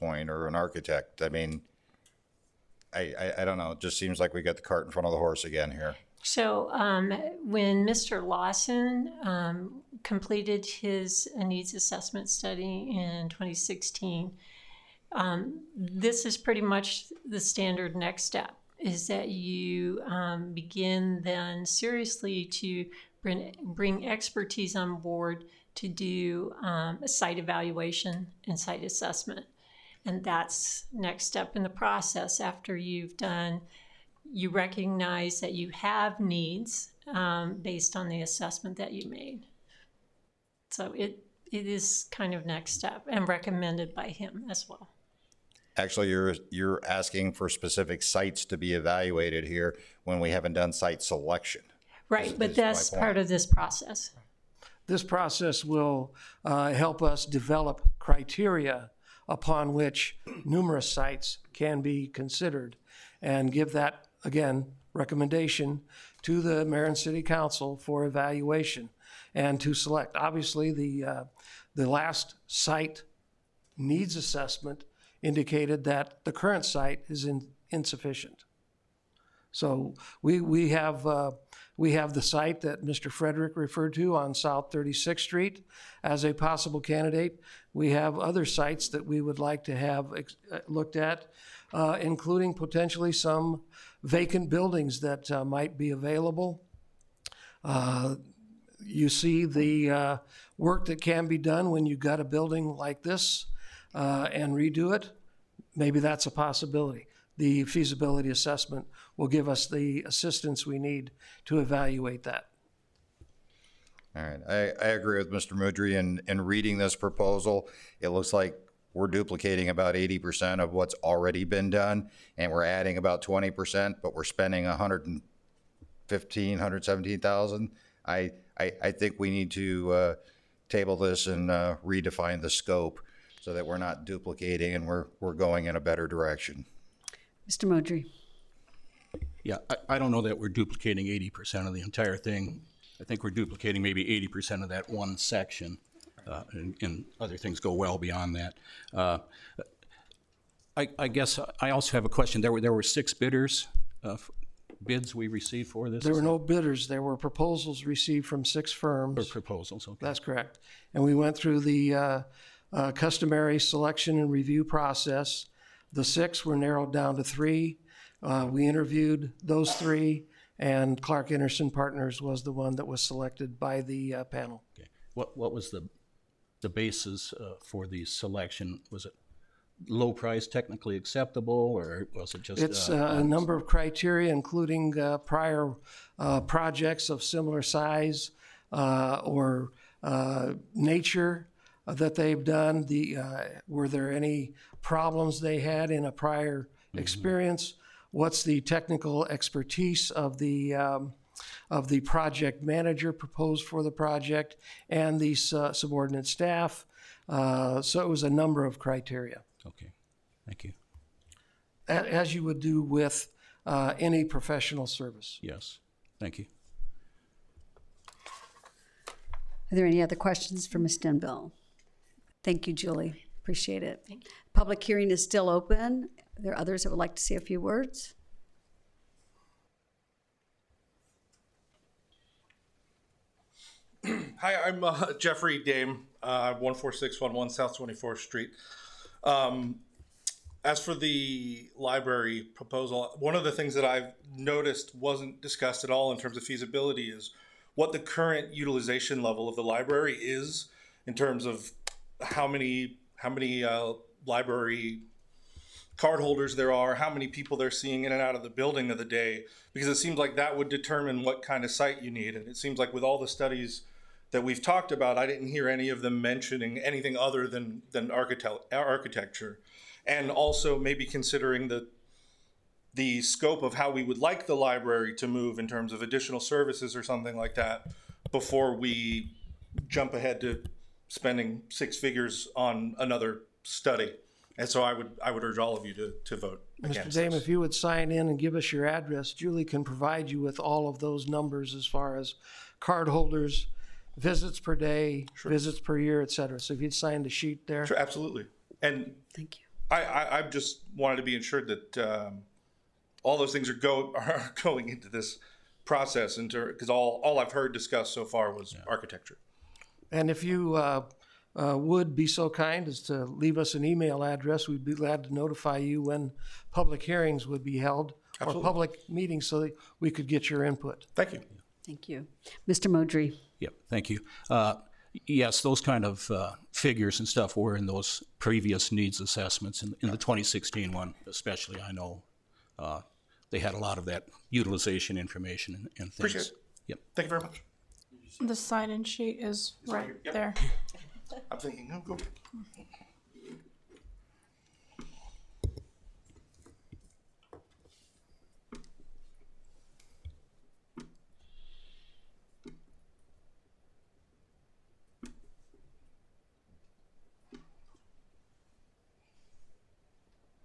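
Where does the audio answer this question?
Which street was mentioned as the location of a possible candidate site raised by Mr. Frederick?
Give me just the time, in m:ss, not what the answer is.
1:24.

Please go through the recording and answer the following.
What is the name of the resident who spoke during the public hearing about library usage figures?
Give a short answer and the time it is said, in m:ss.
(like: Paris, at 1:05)
Jeffrey Dame, at 3:55.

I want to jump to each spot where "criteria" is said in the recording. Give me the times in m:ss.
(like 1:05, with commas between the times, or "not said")
0:57, 3:03, 3:28.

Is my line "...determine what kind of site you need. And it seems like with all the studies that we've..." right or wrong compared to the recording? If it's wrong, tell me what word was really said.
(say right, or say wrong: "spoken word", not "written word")
right.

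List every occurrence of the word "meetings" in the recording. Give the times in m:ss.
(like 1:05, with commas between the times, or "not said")
5:19.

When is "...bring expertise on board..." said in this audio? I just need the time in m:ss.
0:23.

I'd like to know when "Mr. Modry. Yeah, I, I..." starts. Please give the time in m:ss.
2:17.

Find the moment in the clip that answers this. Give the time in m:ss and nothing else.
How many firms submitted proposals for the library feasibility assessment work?
2:38.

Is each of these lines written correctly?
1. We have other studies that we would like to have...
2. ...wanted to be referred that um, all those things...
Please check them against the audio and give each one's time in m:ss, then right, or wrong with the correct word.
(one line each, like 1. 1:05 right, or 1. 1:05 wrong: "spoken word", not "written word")
1. 1:27 wrong: "sites", not "studies"
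2. 5:00 wrong: "ensured", not "referred".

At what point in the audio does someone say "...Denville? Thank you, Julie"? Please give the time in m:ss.
3:40.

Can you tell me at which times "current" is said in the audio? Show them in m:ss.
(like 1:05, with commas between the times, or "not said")
1:16, 4:07.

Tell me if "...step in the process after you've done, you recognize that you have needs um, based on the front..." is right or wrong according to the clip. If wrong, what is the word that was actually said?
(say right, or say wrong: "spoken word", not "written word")
wrong: "assessment", not "front".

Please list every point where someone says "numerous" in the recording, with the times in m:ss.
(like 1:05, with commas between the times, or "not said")
1:00.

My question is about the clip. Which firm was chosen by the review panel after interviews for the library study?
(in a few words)
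Clark Enersen Partners.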